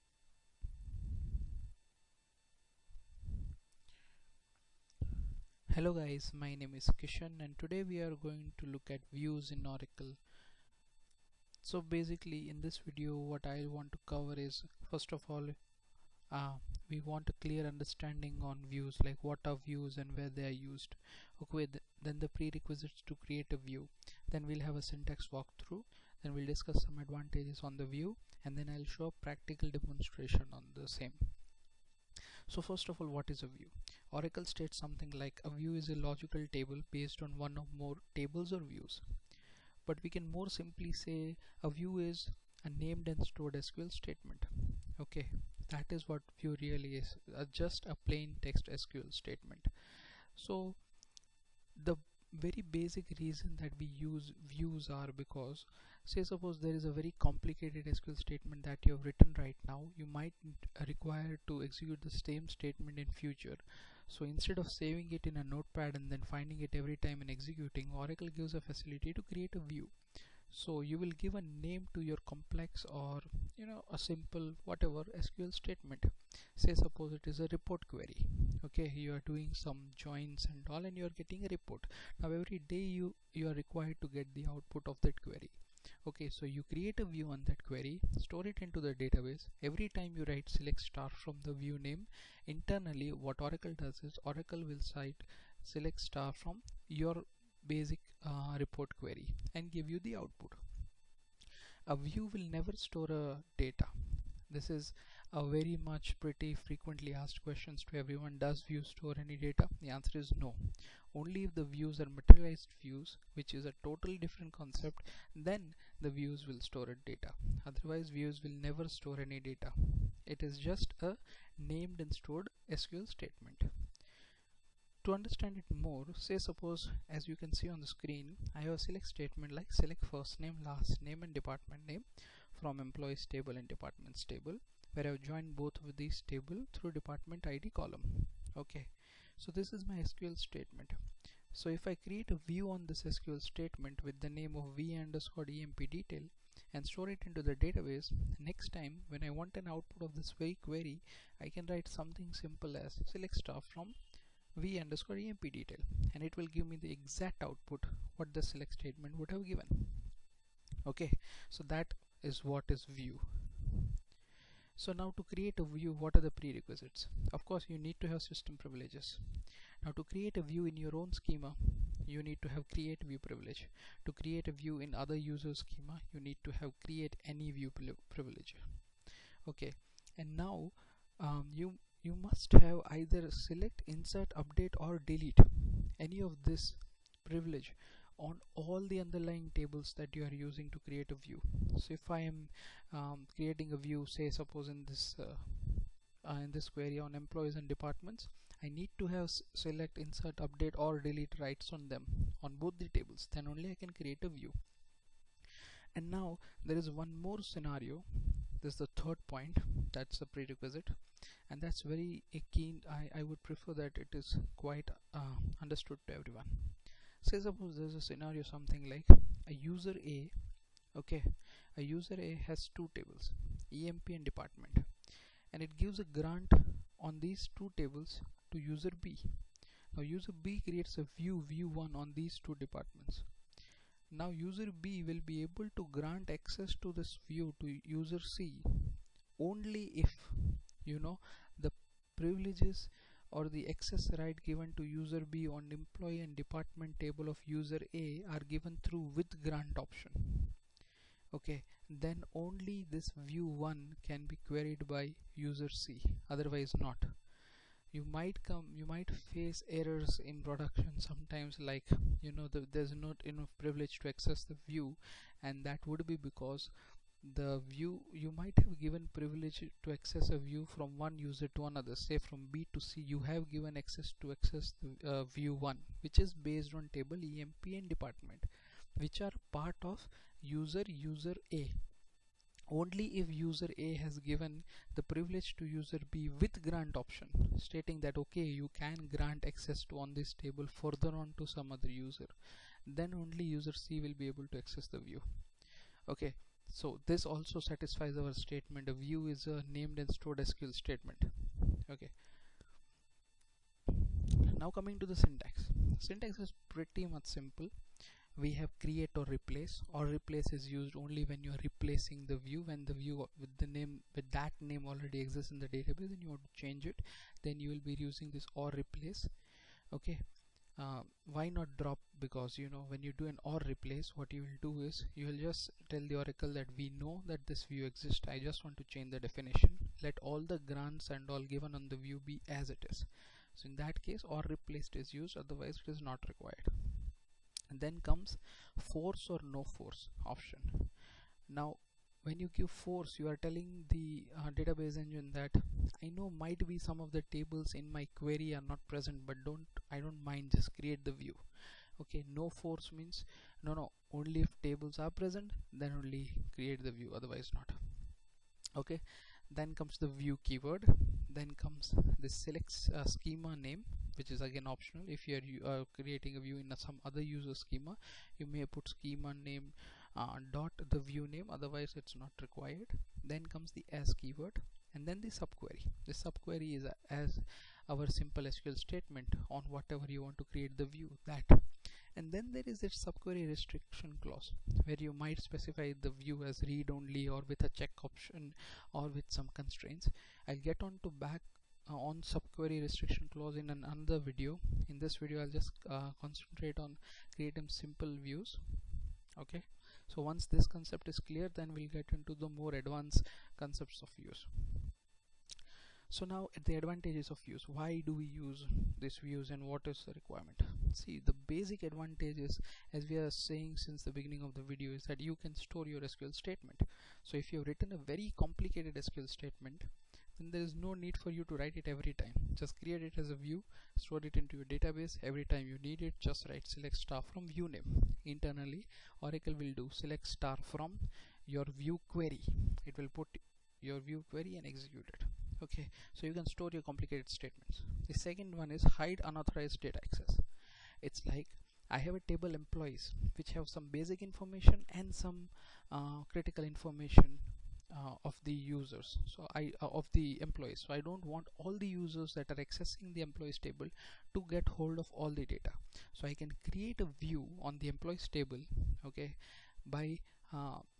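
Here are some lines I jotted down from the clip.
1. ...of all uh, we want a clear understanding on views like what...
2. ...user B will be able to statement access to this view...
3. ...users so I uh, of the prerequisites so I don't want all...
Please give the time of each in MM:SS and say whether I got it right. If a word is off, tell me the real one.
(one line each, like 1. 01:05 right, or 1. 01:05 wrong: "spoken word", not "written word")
1. 00:15 right
2. 03:54 wrong: "grant", not "statement"
3. 07:28 wrong: "employees", not "prerequisites".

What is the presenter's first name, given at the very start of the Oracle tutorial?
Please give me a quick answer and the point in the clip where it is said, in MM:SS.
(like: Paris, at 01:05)
Kishan, at 00:07.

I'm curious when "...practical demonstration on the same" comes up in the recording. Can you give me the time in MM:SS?
00:29.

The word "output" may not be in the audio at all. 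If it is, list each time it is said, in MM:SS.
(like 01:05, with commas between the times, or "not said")
01:24, 01:40, 02:29, 02:37.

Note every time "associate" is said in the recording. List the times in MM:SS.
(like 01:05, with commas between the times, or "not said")
not said.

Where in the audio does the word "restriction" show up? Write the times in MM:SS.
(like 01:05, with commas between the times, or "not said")
06:23, 06:32.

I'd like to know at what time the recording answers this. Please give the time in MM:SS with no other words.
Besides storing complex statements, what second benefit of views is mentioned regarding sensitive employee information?
07:18.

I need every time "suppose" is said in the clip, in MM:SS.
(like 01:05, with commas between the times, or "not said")
00:56, 01:16, 02:06, 03:14, 03:37.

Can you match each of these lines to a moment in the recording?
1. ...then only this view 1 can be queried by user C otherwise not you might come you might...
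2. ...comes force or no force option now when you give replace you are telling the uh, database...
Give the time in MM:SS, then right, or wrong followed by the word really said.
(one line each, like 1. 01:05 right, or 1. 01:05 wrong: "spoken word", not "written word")
1. 04:11 right
2. 05:38 wrong: "force", not "replace".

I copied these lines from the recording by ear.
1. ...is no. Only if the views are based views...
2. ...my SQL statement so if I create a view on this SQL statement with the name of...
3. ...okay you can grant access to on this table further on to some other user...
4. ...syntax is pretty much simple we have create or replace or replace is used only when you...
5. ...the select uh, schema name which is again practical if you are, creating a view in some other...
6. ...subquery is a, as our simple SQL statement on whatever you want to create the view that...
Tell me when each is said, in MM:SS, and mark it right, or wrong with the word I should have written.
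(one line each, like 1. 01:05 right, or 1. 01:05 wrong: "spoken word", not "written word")
1. 01:50 wrong: "materialized", not "based"
2. 02:19 right
3. 04:48 right
4. 05:05 right
5. 06:02 wrong: "optional", not "practical"
6. 06:16 right.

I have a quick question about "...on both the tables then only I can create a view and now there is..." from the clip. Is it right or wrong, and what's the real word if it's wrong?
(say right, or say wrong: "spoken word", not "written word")
right.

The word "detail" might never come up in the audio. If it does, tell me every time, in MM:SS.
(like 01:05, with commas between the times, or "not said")
02:25, 02:35.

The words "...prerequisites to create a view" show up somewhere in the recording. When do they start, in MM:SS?
00:22.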